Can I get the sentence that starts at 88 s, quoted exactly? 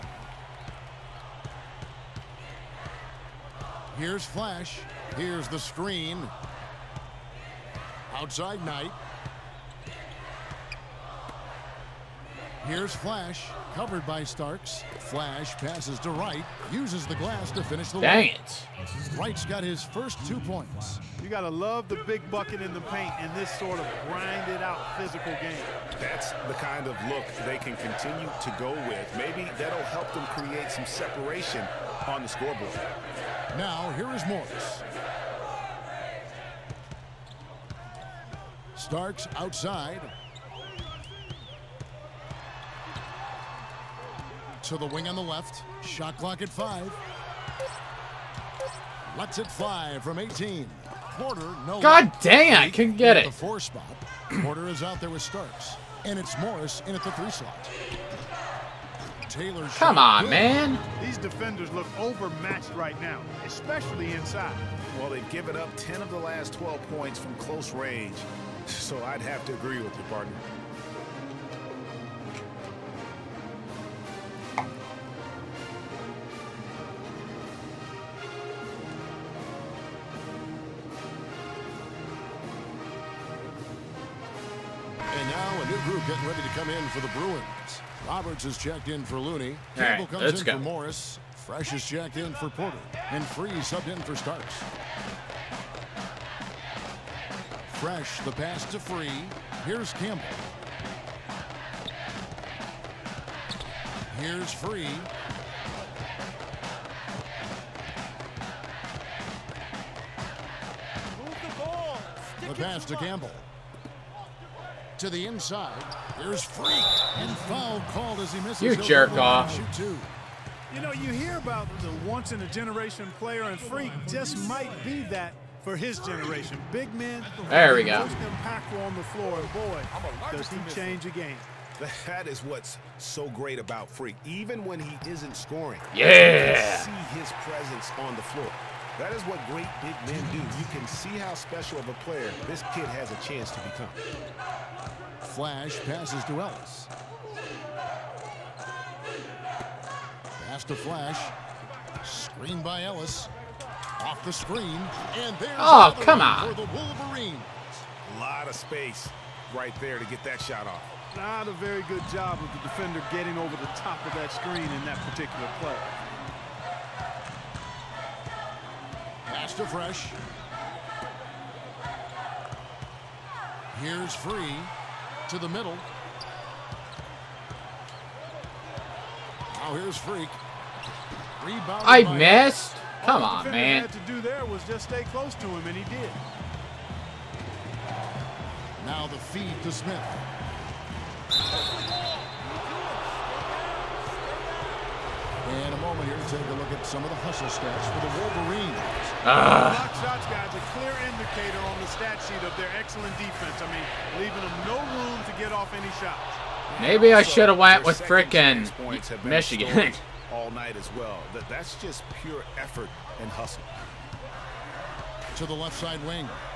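Roberts has checked in for Looney.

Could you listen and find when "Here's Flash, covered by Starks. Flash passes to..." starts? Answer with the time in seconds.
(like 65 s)
12 s.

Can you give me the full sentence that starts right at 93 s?
And Free subbed in for Starks.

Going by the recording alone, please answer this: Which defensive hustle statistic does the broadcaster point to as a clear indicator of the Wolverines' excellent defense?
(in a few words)
Block shots.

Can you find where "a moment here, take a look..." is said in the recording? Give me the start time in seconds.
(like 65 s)
195 s.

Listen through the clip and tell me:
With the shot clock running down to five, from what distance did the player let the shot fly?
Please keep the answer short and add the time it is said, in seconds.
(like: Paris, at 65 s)
18, at 50 s.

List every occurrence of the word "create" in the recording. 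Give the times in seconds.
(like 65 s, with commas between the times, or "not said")
30 s.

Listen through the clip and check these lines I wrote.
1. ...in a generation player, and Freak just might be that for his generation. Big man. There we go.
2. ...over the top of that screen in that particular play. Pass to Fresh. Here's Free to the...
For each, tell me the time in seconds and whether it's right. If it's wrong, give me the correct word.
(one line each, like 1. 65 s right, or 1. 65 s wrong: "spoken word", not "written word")
1. 122 s right
2. 163 s right.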